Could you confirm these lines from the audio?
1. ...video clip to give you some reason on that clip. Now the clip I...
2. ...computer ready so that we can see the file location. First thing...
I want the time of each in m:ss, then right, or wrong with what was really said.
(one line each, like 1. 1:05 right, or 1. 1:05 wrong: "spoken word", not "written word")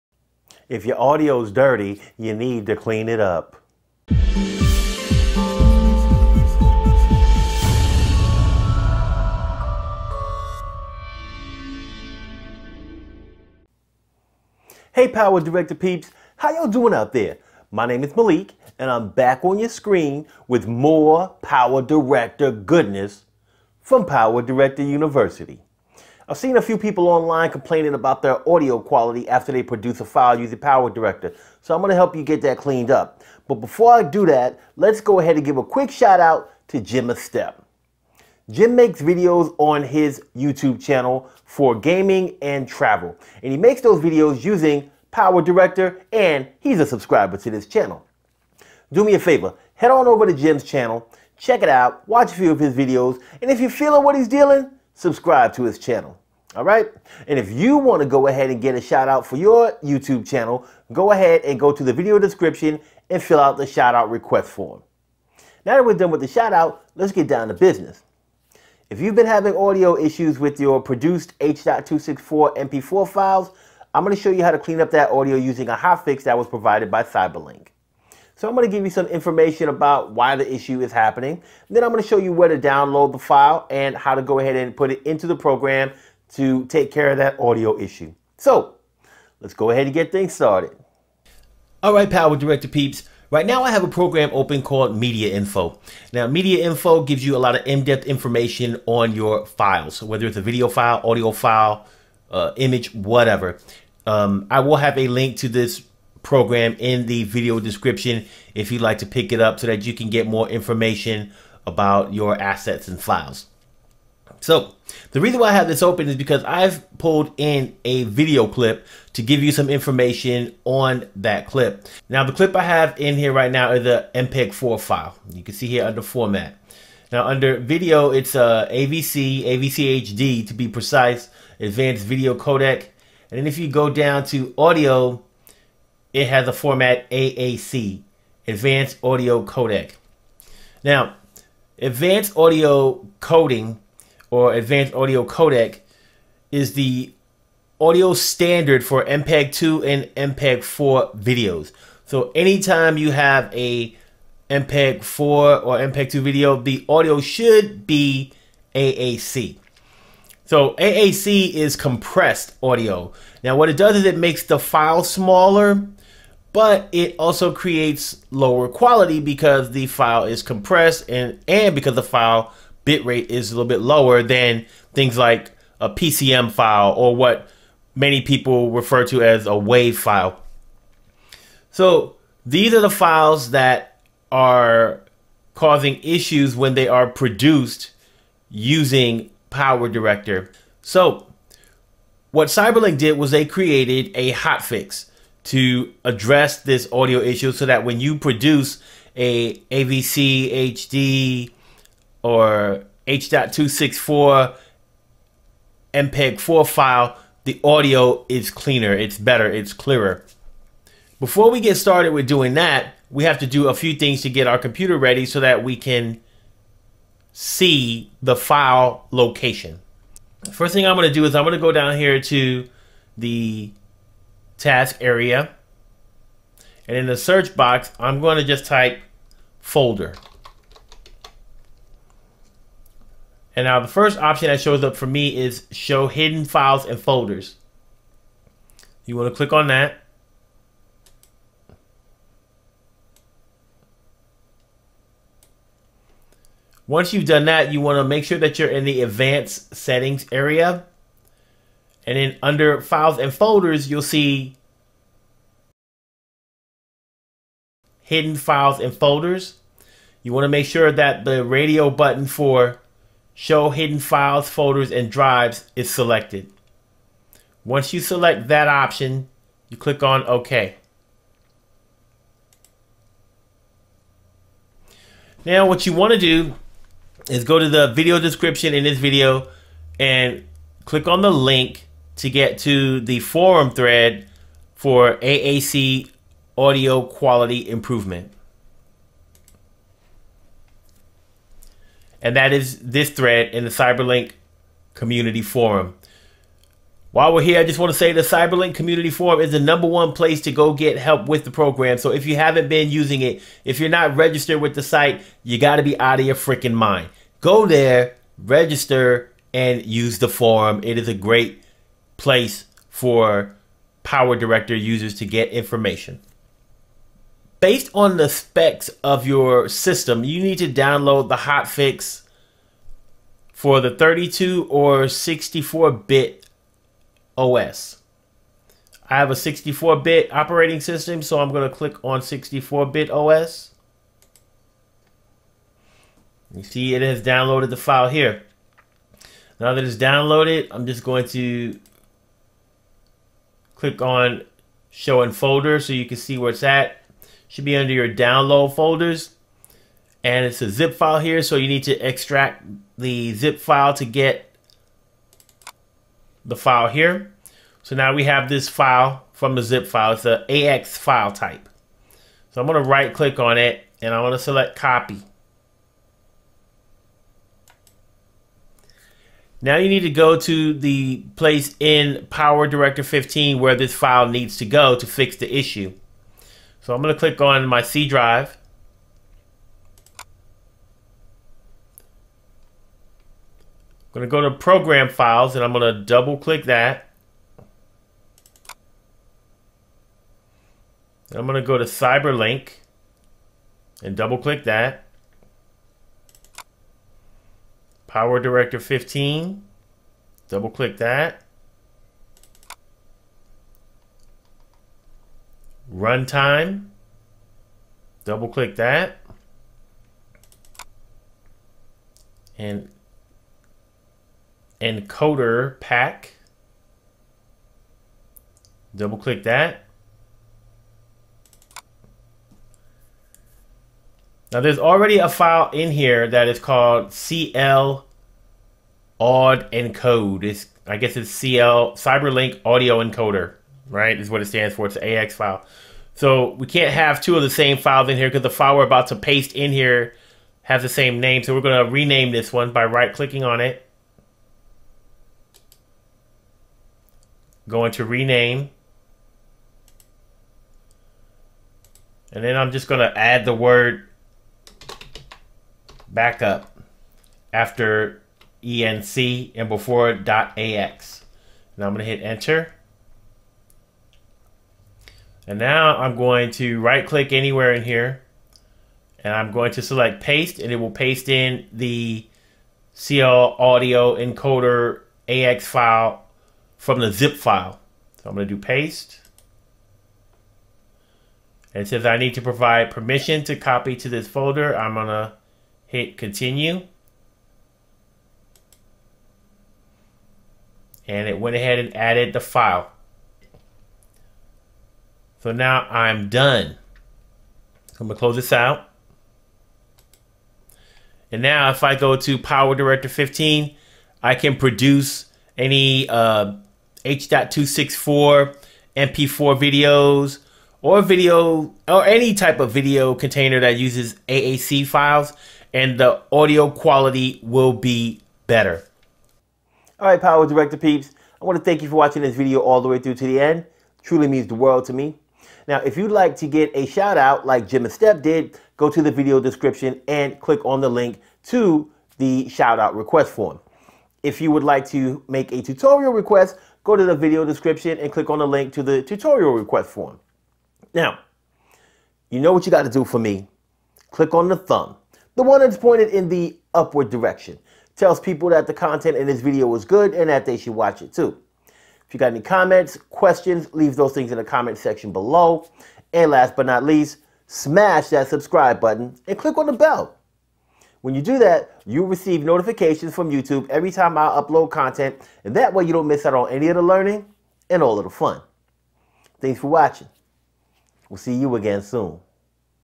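1. 1:58 wrong: "information", not "reason"
2. 3:34 right.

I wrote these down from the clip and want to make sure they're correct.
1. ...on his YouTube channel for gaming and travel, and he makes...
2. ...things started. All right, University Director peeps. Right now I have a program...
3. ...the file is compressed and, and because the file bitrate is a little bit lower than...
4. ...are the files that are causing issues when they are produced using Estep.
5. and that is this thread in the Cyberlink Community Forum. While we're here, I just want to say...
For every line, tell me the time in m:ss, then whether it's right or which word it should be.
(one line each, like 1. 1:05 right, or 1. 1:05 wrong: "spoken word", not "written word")
1. 0:39 right
2. 1:30 wrong: "Power", not "University"
3. 2:49 right
4. 3:02 wrong: "PowerDirector", not "Estep"
5. 4:52 right.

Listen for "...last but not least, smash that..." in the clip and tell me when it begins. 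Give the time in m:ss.
9:16.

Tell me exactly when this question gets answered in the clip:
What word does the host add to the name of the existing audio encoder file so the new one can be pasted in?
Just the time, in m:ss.
7:36.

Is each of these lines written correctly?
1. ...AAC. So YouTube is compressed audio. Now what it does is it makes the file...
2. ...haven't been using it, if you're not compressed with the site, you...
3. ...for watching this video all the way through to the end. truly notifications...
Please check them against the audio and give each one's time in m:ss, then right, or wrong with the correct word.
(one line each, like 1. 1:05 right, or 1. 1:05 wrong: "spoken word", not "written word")
1. 2:38 wrong: "AAC", not "YouTube"
2. 5:02 wrong: "registered", not "compressed"
3. 8:41 wrong: "means", not "notifications".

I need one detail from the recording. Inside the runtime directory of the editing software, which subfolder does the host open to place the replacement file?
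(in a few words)
encoder pack.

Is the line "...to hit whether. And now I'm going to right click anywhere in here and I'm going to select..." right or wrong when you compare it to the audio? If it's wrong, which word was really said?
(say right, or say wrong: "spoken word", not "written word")
wrong: "enter", not "whether".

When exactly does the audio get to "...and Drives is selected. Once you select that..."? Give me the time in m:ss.
4:24.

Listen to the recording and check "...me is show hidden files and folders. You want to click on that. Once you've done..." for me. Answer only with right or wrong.
right.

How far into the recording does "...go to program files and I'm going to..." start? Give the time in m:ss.
6:24.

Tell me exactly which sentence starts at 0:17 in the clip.
My name is Malik and I'm back on your screen with more Power Director goodness from Power Director University.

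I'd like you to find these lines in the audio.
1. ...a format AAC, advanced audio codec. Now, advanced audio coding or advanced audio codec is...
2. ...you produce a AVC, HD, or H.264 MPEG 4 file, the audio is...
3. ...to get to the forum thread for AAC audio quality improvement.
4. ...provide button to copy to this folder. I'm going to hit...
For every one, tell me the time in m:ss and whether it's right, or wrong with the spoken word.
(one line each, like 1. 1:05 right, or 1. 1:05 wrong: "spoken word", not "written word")
1. 2:16 right
2. 3:17 right
3. 4:42 right
4. 8:02 wrong: "permission", not "button".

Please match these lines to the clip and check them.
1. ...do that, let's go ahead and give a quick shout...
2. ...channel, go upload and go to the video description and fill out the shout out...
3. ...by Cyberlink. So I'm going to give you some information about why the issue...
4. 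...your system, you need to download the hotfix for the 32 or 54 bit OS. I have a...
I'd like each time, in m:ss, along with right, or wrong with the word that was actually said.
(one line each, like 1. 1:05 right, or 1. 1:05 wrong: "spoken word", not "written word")
1. 0:34 right
2. 1:00 wrong: "ahead", not "upload"
3. 1:16 right
4. 5:19 wrong: "64", not "54".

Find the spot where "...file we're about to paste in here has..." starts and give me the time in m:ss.
7:18.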